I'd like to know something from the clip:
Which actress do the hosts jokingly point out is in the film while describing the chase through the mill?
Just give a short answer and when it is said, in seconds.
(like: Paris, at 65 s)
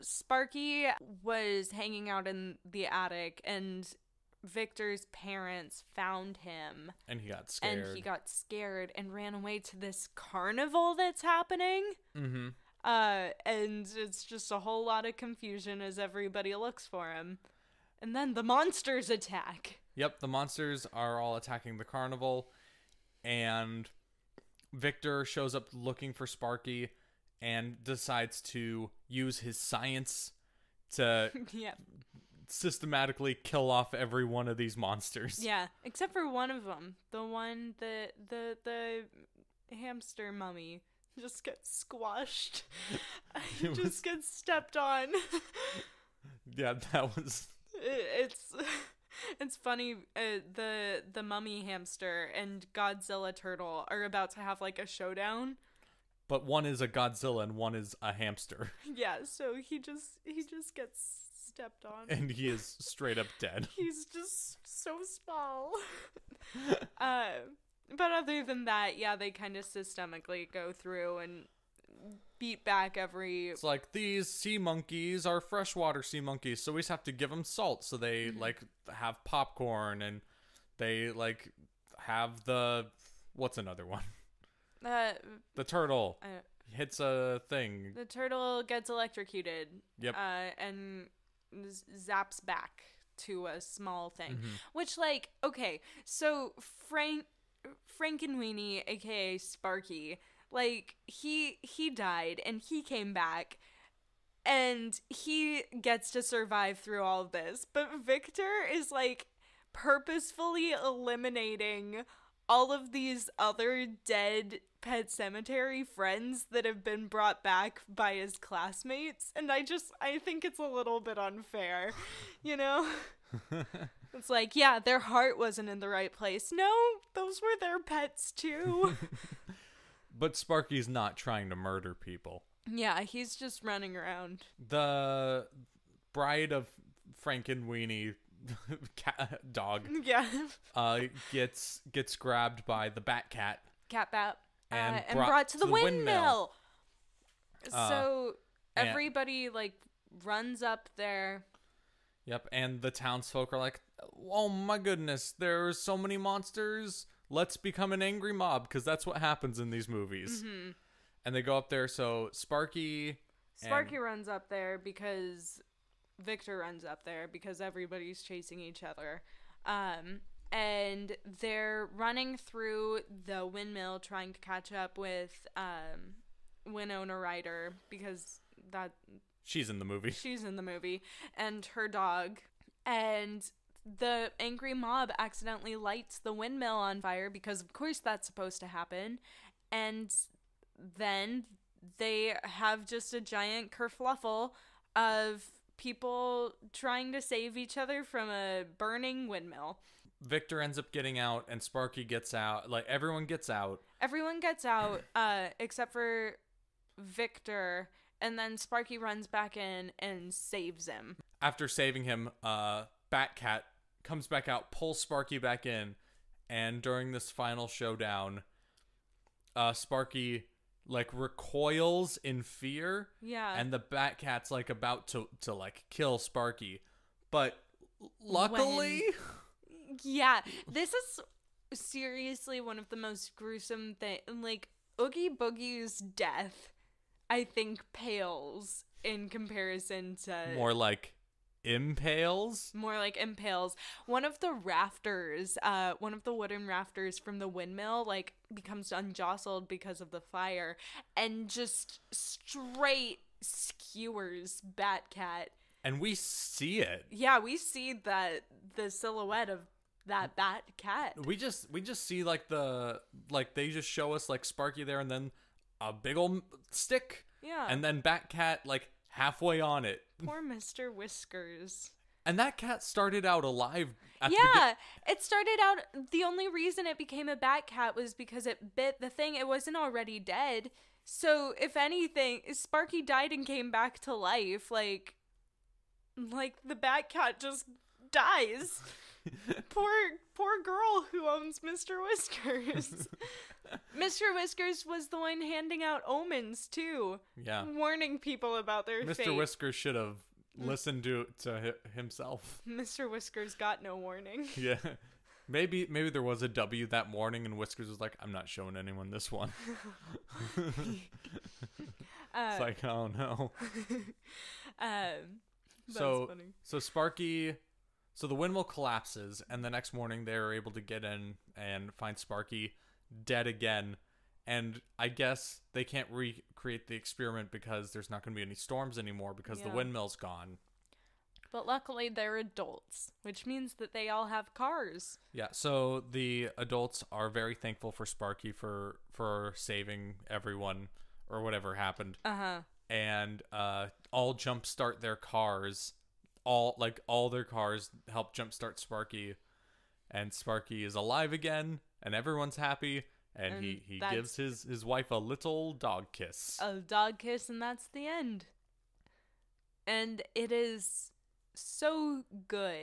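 Winona Ryder, at 176 s.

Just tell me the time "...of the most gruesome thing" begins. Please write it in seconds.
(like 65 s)
232 s.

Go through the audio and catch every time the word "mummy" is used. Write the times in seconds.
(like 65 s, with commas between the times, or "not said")
40 s, 51 s.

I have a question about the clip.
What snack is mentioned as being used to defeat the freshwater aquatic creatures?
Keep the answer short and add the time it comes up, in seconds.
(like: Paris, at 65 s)
popcorn, at 79 s.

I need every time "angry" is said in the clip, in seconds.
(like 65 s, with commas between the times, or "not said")
158 s, 184 s.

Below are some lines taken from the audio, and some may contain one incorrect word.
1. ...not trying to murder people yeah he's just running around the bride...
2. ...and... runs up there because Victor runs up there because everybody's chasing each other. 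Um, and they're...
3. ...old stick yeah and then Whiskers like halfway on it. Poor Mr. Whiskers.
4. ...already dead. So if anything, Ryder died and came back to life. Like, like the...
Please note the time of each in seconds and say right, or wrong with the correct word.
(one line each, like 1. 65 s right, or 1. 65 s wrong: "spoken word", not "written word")
1. 130 s right
2. 163 s right
3. 266 s wrong: "Batcat", not "Whiskers"
4. 279 s wrong: "Sparky", not "Ryder".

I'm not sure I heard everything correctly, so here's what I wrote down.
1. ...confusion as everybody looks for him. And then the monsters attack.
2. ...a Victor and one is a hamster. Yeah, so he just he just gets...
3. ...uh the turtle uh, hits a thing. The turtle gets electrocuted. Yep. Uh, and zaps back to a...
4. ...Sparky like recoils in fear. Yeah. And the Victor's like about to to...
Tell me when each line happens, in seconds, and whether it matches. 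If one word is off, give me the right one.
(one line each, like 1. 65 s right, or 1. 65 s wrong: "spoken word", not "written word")
1. 15 s right
2. 56 s wrong: "Godzilla", not "Victor"
3. 84 s right
4. 219 s wrong: "Batcat", not "Victor".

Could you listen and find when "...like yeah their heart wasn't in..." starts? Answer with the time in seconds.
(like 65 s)
124 s.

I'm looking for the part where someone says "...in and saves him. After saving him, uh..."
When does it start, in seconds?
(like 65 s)
209 s.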